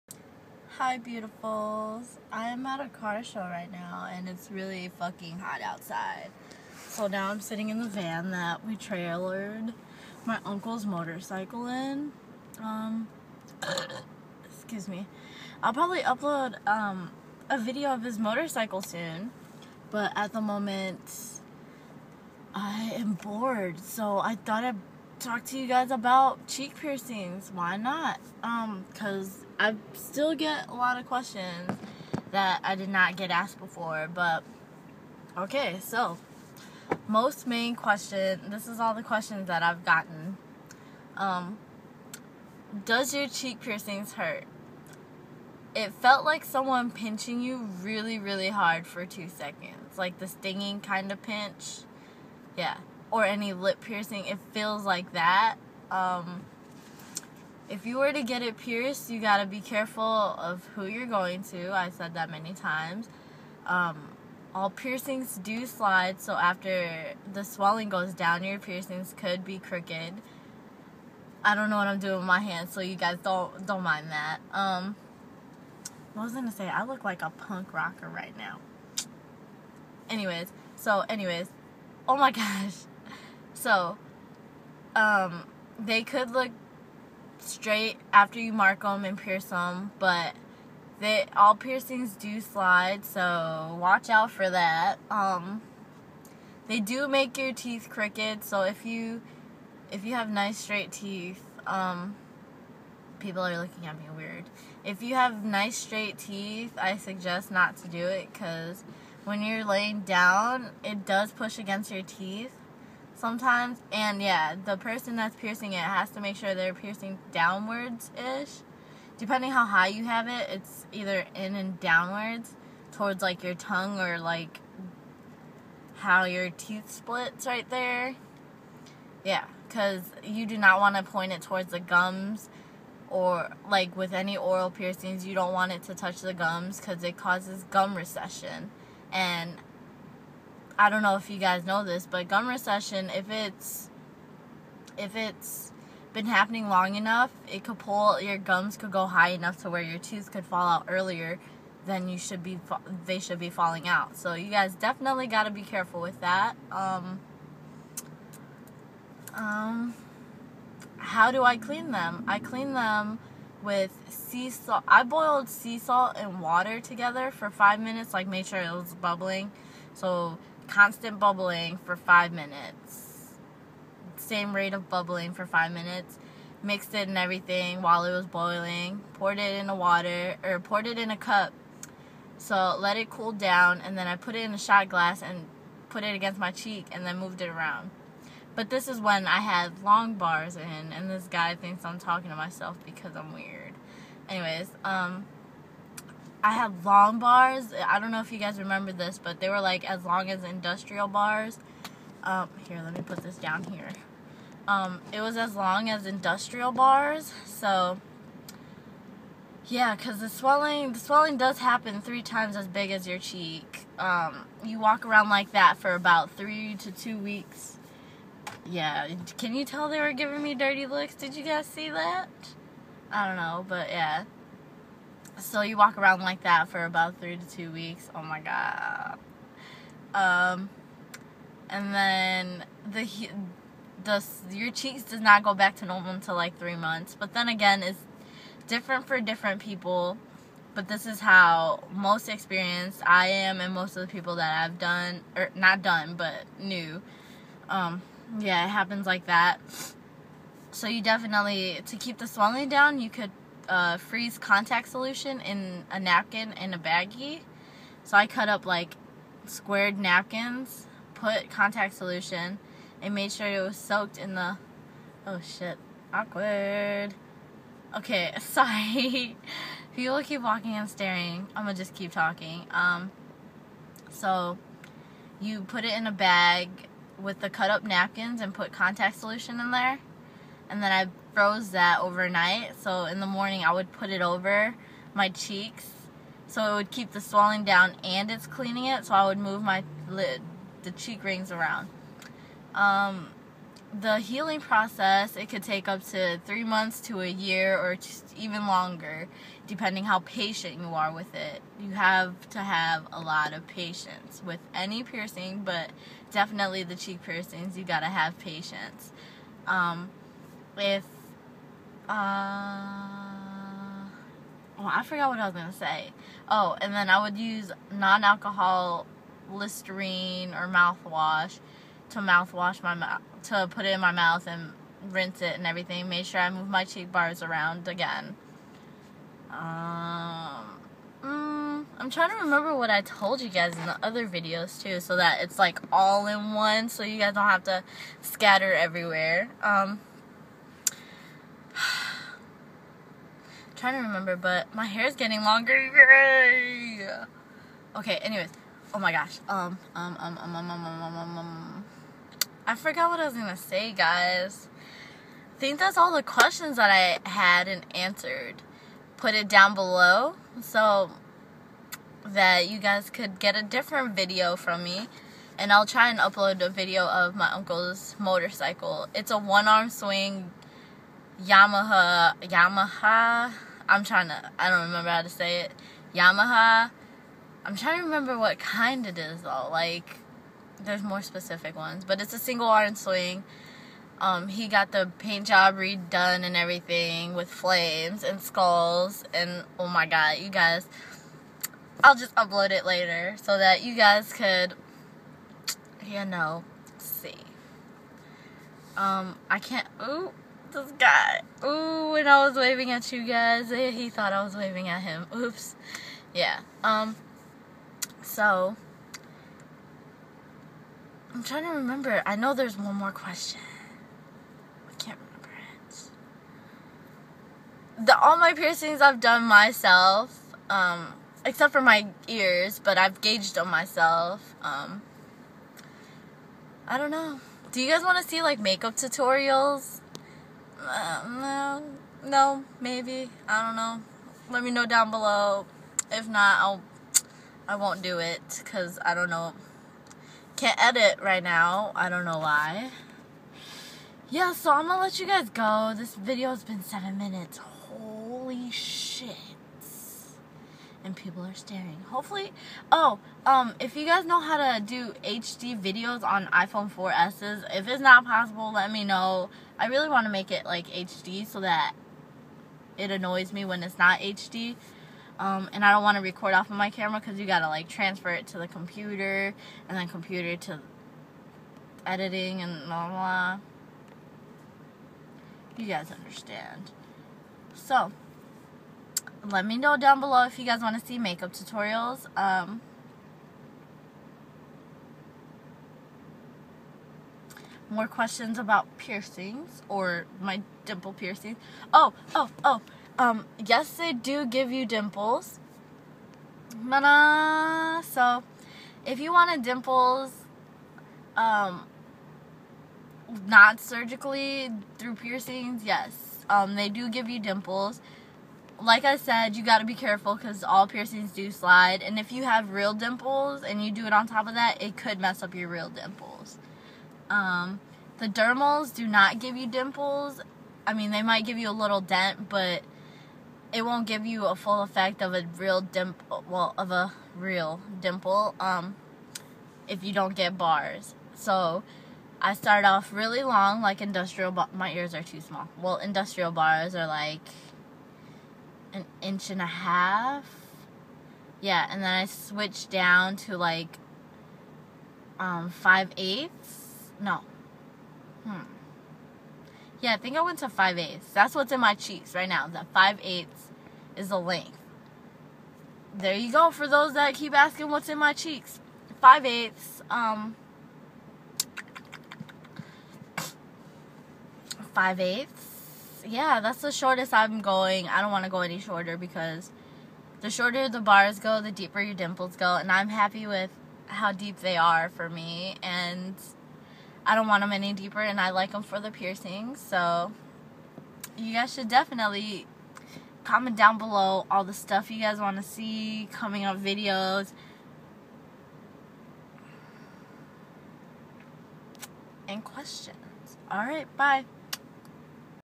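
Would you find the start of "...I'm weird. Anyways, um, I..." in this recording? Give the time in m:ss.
3:13.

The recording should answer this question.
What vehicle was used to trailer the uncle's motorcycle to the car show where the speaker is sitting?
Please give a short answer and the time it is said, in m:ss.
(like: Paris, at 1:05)
van, at 0:07.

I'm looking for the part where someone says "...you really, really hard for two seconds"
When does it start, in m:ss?
0:47.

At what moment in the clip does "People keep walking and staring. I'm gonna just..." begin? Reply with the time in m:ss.
4:29.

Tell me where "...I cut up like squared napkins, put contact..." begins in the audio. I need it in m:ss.
4:18.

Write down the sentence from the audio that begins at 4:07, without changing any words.
Um, yeah, it happens like that.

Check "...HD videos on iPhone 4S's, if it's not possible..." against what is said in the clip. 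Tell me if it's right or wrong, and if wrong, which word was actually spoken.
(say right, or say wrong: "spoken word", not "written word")
right.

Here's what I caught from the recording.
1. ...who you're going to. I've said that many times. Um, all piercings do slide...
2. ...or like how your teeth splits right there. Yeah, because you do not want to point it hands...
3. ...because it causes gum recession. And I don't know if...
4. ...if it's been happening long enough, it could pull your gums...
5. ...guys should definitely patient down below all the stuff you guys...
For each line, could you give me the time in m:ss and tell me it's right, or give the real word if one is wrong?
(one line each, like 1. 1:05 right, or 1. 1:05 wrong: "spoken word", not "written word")
1. 1:00 right
2. 2:04 wrong: "towards", not "hands"
3. 2:16 right
4. 2:24 right
5. 9:41 wrong: "comment", not "patient".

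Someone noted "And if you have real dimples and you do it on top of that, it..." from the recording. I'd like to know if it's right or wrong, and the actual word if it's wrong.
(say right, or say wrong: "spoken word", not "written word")
right.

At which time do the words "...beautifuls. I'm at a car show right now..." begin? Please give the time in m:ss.
0:00.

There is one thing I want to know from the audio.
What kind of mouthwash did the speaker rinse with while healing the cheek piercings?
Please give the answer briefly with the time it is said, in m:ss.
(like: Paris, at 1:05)
non-alcohol Listerine, at 5:17.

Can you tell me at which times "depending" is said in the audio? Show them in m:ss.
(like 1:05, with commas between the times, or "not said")
1:59, 4:59.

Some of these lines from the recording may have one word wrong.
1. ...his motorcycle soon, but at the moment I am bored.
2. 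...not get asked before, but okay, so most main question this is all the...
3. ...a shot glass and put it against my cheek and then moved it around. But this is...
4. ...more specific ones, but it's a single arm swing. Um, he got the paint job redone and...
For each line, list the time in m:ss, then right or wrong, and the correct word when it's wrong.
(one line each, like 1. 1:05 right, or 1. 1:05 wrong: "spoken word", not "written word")
1. 0:18 right
2. 0:32 right
3. 3:04 right
4. 6:21 right.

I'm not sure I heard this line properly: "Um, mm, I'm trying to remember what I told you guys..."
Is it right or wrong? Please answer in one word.
right.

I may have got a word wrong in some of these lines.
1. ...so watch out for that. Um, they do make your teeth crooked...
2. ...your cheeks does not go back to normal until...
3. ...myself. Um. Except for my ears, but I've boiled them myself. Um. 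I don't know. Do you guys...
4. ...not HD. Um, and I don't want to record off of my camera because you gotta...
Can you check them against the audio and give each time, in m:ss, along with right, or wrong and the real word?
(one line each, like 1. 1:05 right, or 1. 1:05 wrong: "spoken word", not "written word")
1. 1:33 right
2. 3:54 right
3. 6:59 wrong: "gauged", not "boiled"
4. 7:43 right.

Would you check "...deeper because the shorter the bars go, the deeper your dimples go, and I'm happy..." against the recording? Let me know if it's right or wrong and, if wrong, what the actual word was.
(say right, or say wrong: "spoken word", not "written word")
wrong: "shorter", not "deeper".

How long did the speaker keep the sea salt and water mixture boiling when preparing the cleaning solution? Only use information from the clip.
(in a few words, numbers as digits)
5 minutes.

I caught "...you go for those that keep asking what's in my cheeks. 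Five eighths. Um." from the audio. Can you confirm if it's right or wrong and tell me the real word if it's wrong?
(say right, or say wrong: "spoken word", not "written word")
right.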